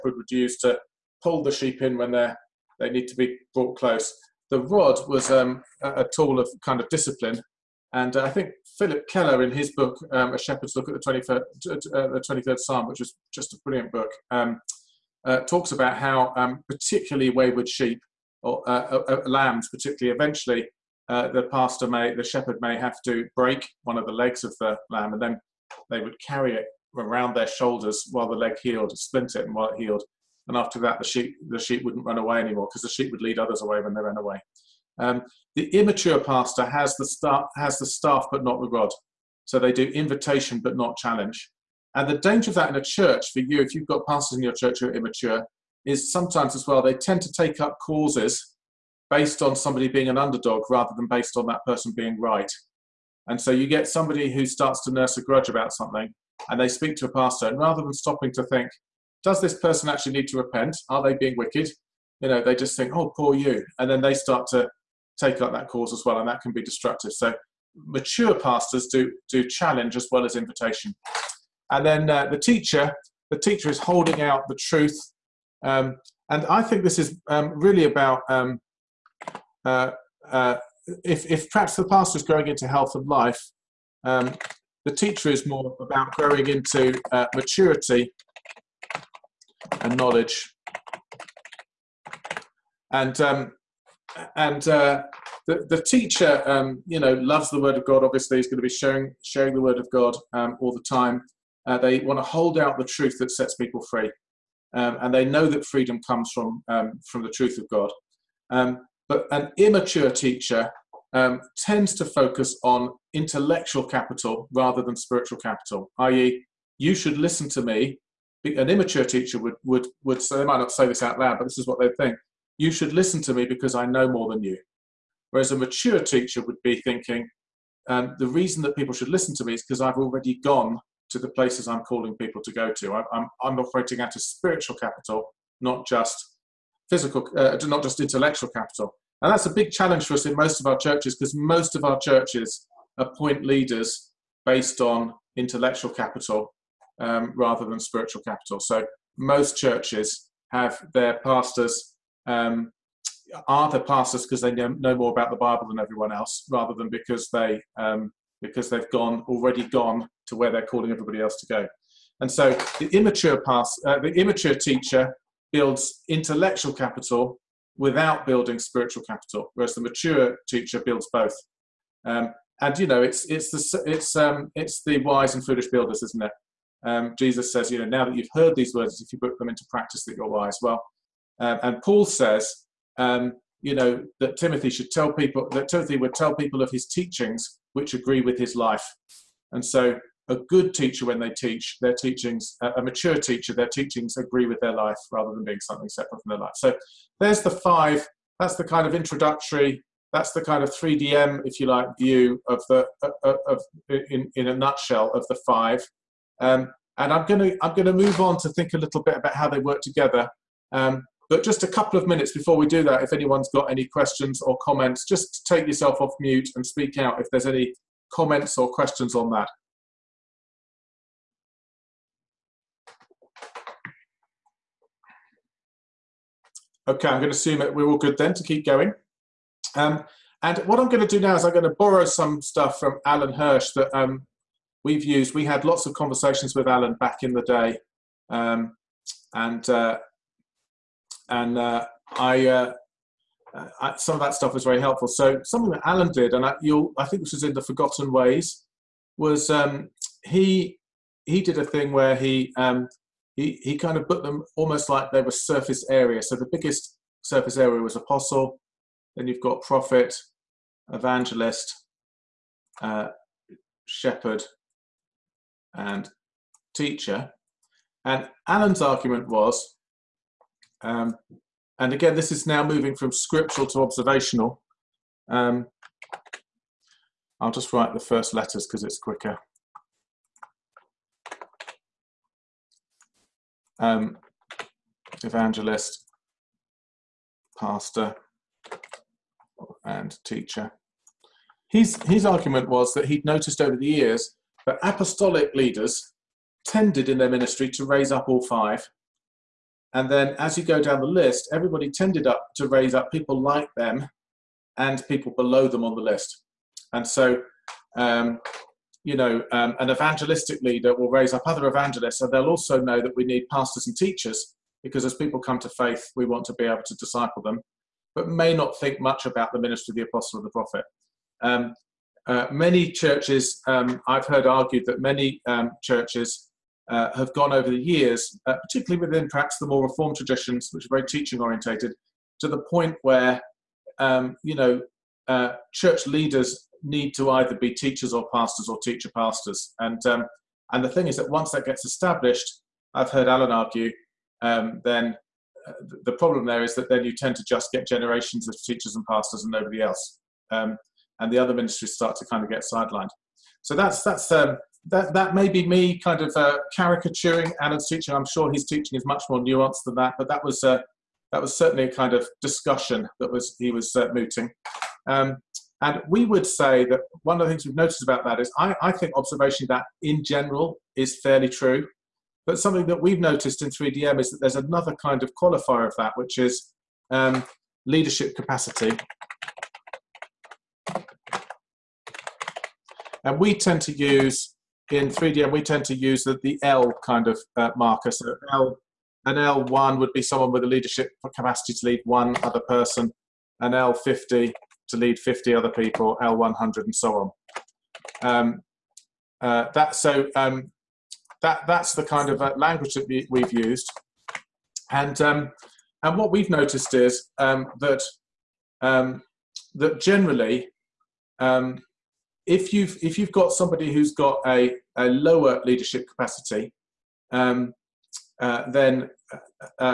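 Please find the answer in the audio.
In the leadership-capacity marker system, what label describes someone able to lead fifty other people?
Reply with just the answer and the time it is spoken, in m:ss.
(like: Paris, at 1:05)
L50, at 6:33.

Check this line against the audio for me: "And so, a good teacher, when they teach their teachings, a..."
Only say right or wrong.
right.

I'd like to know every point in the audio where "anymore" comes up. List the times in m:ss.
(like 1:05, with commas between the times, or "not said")
0:32.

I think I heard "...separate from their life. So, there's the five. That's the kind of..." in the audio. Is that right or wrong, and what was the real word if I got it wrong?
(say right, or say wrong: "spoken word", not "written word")
right.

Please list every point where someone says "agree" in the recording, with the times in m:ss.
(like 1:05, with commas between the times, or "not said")
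3:07, 3:14.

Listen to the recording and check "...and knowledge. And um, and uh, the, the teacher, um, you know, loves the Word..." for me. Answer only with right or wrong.
right.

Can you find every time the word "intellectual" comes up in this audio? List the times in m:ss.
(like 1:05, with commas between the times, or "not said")
1:53, 2:18, 2:25, 2:46.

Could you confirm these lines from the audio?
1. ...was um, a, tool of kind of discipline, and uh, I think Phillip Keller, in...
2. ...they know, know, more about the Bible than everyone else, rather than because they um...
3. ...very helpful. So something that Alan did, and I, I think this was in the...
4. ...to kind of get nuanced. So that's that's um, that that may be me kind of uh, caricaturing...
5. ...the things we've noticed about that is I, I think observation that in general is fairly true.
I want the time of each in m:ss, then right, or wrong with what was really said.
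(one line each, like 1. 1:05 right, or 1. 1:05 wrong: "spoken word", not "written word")
1. 0:05 right
2. 2:34 right
3. 4:04 right
4. 5:52 wrong: "sidelined", not "nuanced"
5. 6:07 right.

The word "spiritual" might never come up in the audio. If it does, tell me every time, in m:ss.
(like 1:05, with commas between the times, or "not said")
1:54, 2:14, 2:27, 2:48.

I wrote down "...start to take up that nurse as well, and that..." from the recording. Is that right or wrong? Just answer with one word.
wrong.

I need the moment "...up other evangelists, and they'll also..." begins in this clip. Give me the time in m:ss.
5:11.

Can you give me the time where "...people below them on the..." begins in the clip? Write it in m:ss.
5:05.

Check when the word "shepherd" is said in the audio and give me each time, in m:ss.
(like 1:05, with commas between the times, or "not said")
0:10, 0:22, 4:23.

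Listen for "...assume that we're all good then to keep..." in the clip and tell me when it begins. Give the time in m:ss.
3:47.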